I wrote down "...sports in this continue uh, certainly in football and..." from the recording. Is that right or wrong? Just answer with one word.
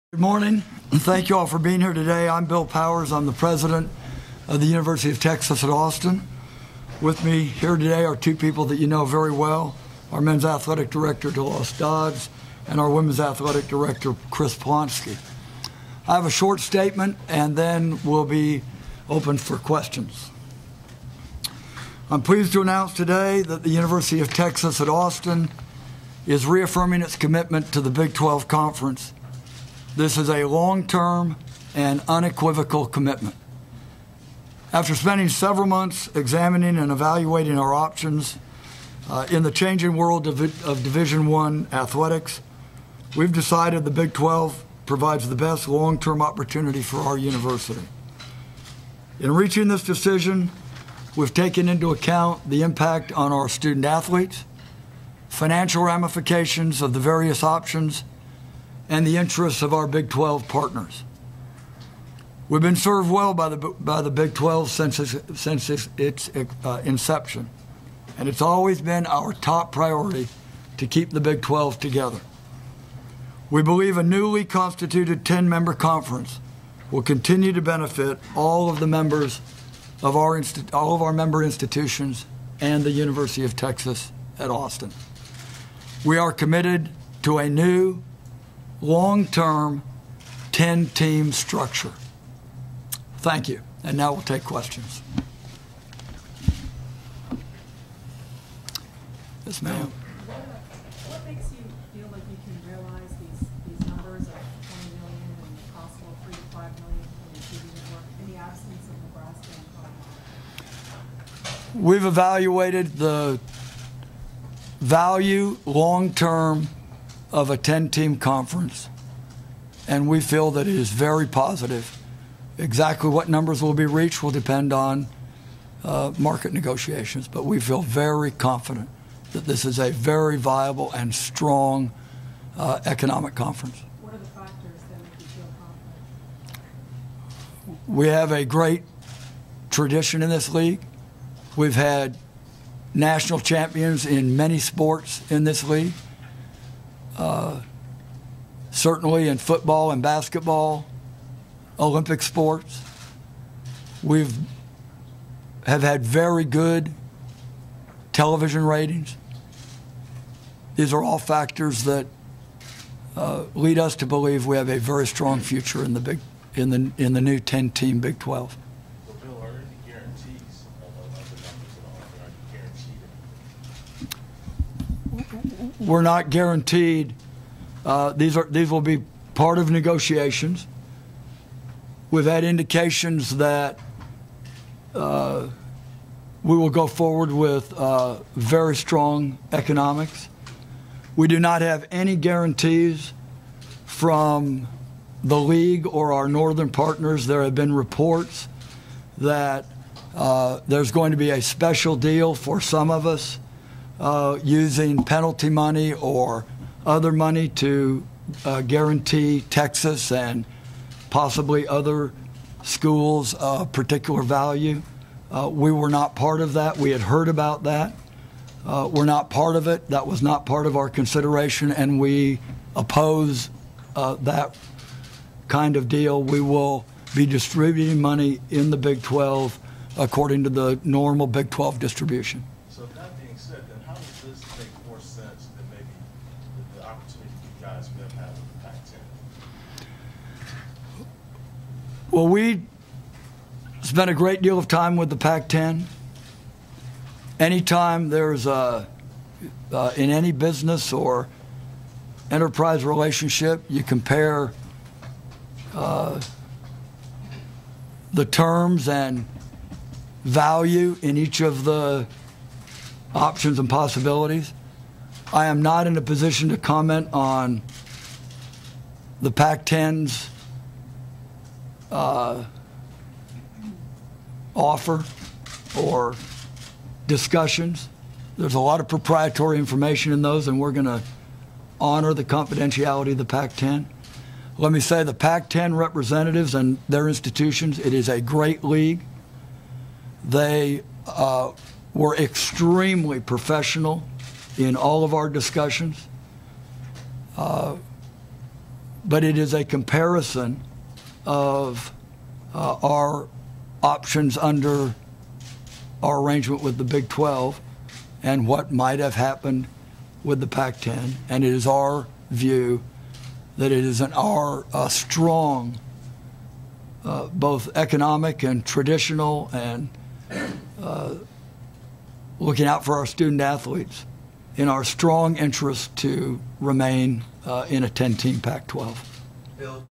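wrong.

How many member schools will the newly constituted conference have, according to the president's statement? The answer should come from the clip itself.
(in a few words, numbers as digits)
10.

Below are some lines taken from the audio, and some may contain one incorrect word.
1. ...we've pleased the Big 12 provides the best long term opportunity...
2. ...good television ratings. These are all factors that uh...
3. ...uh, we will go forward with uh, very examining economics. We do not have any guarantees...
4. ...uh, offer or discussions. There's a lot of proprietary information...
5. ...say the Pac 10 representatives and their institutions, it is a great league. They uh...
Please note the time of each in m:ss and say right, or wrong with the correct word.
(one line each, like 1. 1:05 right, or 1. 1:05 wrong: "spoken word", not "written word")
1. 0:43 wrong: "decided", not "pleased"
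2. 2:36 right
3. 3:04 wrong: "strong", not "examining"
4. 4:31 right
5. 4:44 right.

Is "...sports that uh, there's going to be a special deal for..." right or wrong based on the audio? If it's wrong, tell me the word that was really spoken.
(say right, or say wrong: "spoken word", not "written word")
wrong: "reports", not "sports".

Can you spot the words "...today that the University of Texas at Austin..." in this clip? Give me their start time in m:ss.
0:22.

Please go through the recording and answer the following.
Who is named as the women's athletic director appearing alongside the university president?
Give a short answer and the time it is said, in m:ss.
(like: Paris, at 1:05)
Chris Plonsky, at 0:14.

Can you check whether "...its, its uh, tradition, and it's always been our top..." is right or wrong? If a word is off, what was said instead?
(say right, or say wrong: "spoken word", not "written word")
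wrong: "inception", not "tradition".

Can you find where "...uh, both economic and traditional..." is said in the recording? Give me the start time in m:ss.
5:17.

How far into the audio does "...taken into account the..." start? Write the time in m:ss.
0:51.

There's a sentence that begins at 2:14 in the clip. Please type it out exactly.
What are the factors that make you feel confident?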